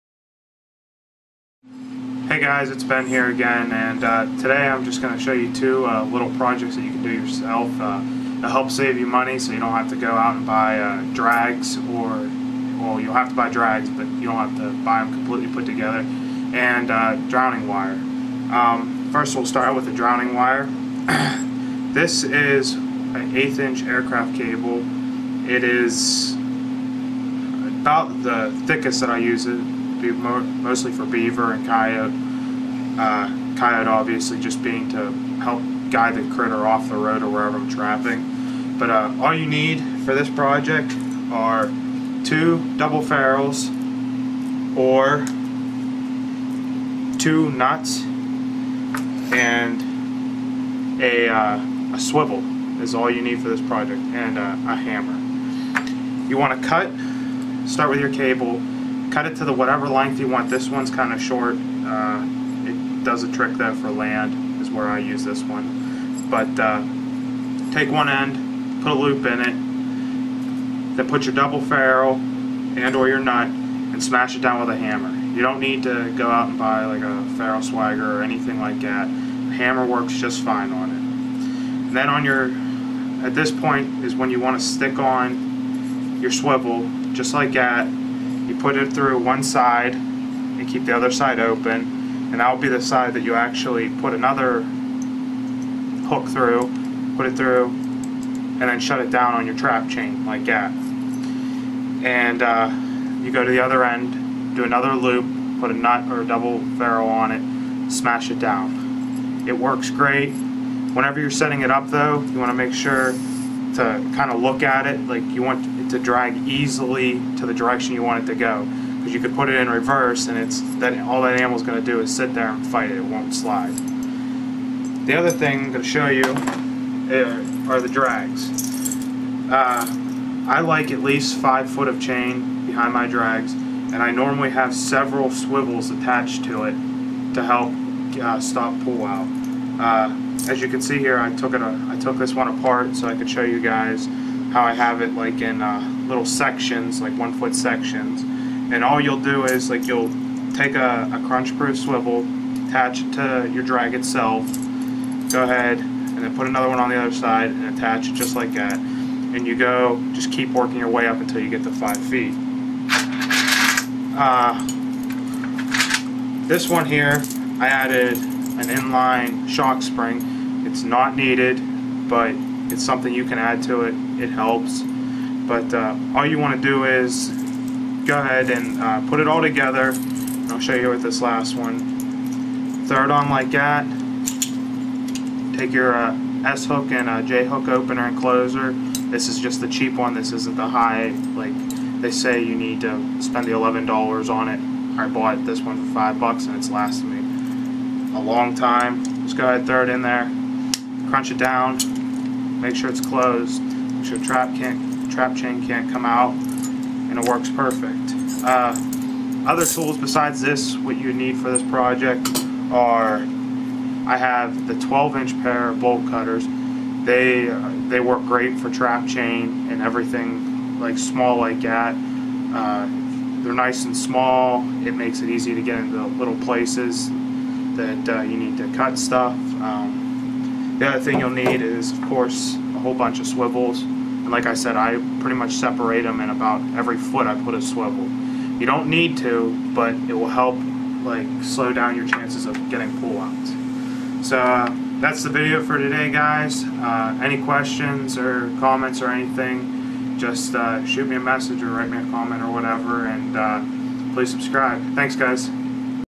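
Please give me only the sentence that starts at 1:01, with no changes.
Uh, it does a trick though for land is where I use this one.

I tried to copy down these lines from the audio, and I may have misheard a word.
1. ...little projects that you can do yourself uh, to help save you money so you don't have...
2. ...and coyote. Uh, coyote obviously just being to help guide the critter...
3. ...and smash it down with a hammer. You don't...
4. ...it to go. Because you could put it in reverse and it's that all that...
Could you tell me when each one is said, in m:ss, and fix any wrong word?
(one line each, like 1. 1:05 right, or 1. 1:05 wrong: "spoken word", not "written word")
1. 0:06 right
2. 0:31 right
3. 1:13 right
4. 1:58 right.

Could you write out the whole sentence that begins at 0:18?
Um, first we'll start with the drowning wire.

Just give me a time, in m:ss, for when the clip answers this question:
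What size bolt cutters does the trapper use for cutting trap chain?
3:34.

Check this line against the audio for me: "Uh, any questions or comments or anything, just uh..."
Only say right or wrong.
right.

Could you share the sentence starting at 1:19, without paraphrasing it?
The hammer works just fine on it.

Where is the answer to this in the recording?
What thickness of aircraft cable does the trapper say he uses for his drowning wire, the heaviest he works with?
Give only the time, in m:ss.
0:23.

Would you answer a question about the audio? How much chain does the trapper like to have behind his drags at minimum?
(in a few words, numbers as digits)
5 feet.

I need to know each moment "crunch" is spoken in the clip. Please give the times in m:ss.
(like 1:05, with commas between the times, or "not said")
2:31, 3:21.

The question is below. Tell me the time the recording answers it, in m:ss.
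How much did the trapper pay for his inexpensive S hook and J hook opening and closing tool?
3:15.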